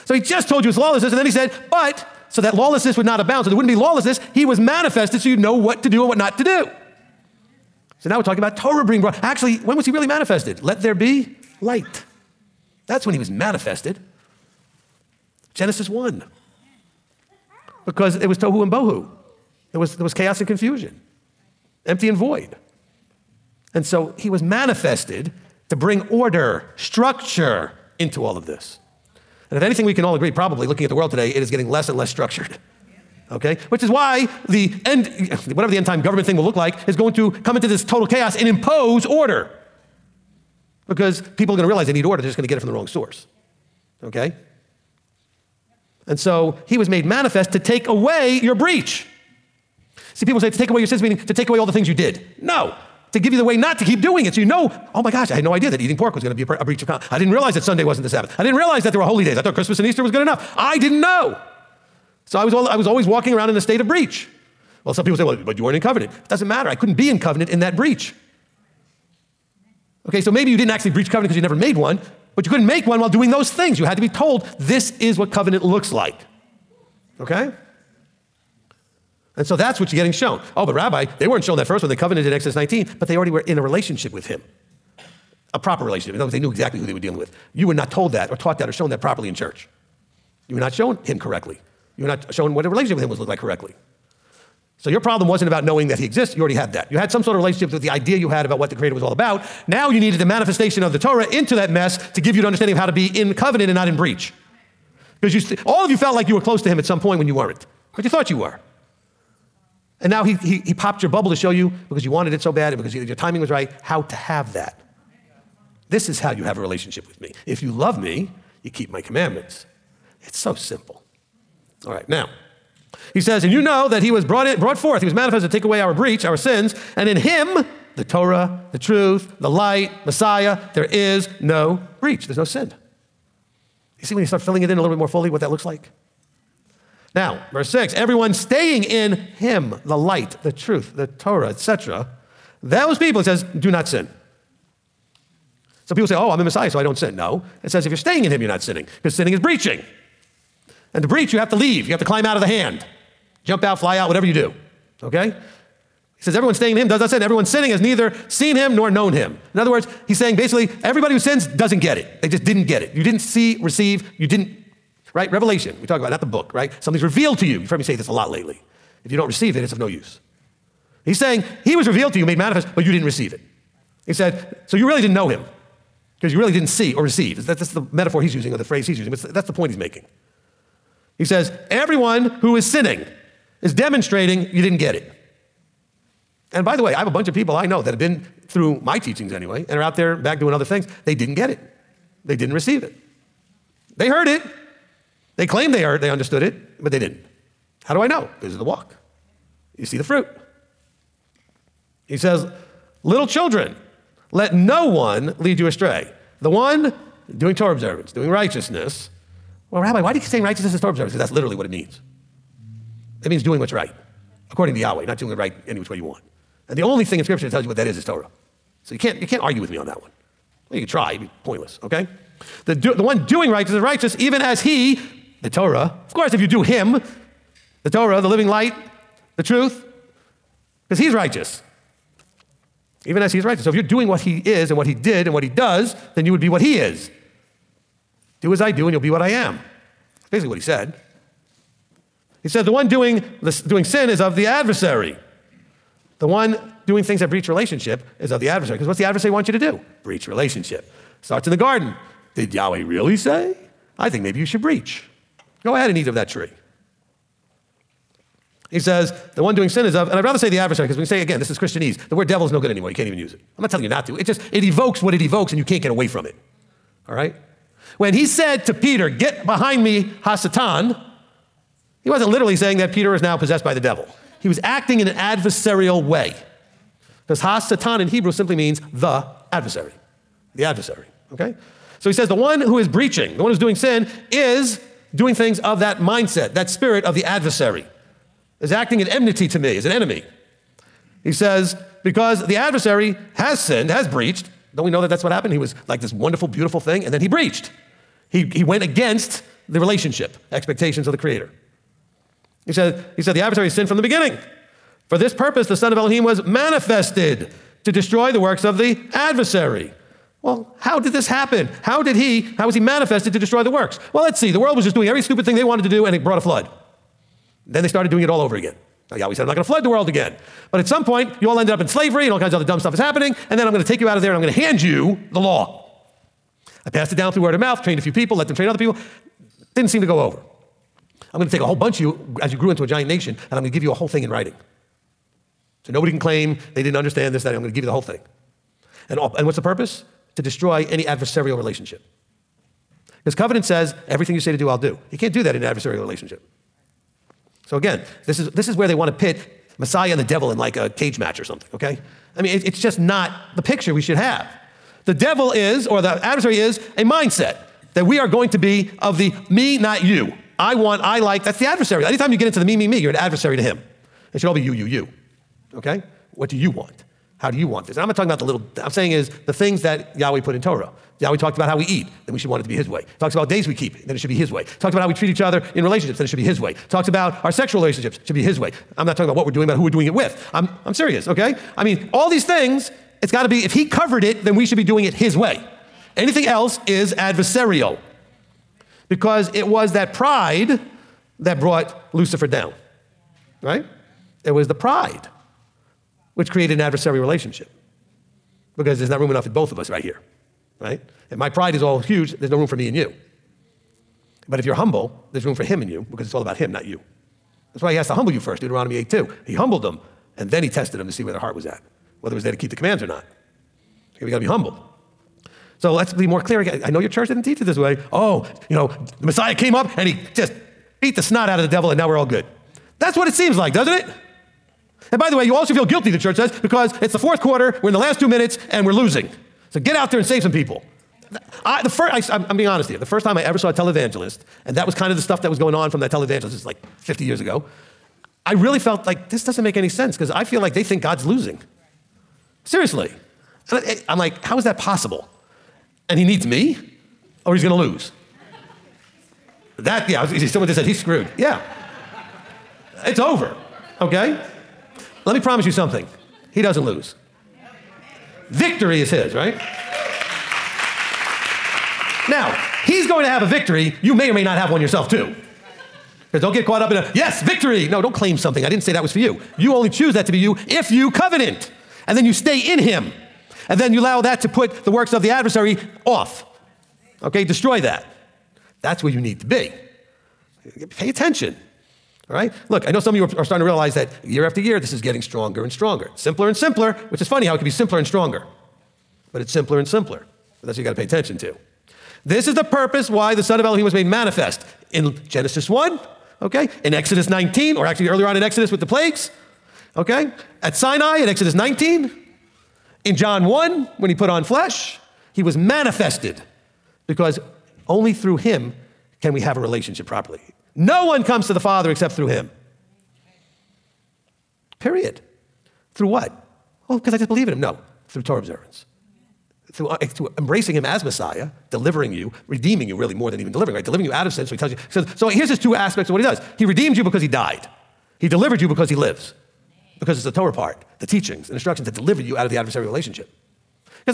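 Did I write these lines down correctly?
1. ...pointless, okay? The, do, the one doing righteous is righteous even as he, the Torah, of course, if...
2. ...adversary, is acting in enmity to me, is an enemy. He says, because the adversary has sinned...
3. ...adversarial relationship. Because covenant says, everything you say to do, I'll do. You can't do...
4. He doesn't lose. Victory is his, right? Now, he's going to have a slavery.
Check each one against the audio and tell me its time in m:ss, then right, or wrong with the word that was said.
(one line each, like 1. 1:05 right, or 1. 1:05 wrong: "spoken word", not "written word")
1. 3:41 right
2. 4:47 right
3. 5:41 right
4. 7:36 wrong: "victory", not "slavery".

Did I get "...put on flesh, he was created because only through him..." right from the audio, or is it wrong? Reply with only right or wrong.
wrong.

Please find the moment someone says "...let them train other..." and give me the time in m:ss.
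5:28.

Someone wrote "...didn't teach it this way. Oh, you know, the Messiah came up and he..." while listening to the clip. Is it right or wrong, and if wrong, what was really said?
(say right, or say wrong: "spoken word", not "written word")
right.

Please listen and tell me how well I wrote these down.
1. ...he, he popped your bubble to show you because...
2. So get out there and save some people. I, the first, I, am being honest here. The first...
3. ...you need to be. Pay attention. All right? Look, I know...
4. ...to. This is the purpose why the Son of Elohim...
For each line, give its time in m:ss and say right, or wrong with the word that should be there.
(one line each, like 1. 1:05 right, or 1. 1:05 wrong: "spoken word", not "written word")
1. 1:50 right
2. 7:09 right
3. 7:59 right
4. 8:11 right.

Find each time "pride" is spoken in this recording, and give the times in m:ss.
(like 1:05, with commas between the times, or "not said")
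6:30, 6:34, 6:41.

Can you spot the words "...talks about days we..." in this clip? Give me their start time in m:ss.
6:13.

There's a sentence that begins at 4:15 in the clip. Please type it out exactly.
Go ahead and eat of that tree.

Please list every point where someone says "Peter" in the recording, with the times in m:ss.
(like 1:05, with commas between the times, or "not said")
4:28, 4:32.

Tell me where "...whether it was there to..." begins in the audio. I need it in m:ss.
6:52.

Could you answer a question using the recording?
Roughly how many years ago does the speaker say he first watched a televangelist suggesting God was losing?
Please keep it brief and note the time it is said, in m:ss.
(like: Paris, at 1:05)
50 years, at 7:17.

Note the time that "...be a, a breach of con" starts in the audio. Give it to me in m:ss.
0:56.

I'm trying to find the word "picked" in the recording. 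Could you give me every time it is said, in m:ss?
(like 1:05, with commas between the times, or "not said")
not said.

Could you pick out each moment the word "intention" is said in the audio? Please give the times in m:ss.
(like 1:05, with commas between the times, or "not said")
not said.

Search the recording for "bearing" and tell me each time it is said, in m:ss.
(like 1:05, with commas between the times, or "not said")
not said.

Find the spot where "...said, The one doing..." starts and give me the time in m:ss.
4:02.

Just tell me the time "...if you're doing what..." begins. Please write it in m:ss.
3:53.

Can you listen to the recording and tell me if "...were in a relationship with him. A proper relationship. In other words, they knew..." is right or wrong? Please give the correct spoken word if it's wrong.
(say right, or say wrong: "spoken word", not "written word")
right.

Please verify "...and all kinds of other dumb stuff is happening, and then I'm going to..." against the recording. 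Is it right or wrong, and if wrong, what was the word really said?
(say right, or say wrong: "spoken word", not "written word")
right.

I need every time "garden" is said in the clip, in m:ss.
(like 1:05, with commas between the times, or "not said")
4:11.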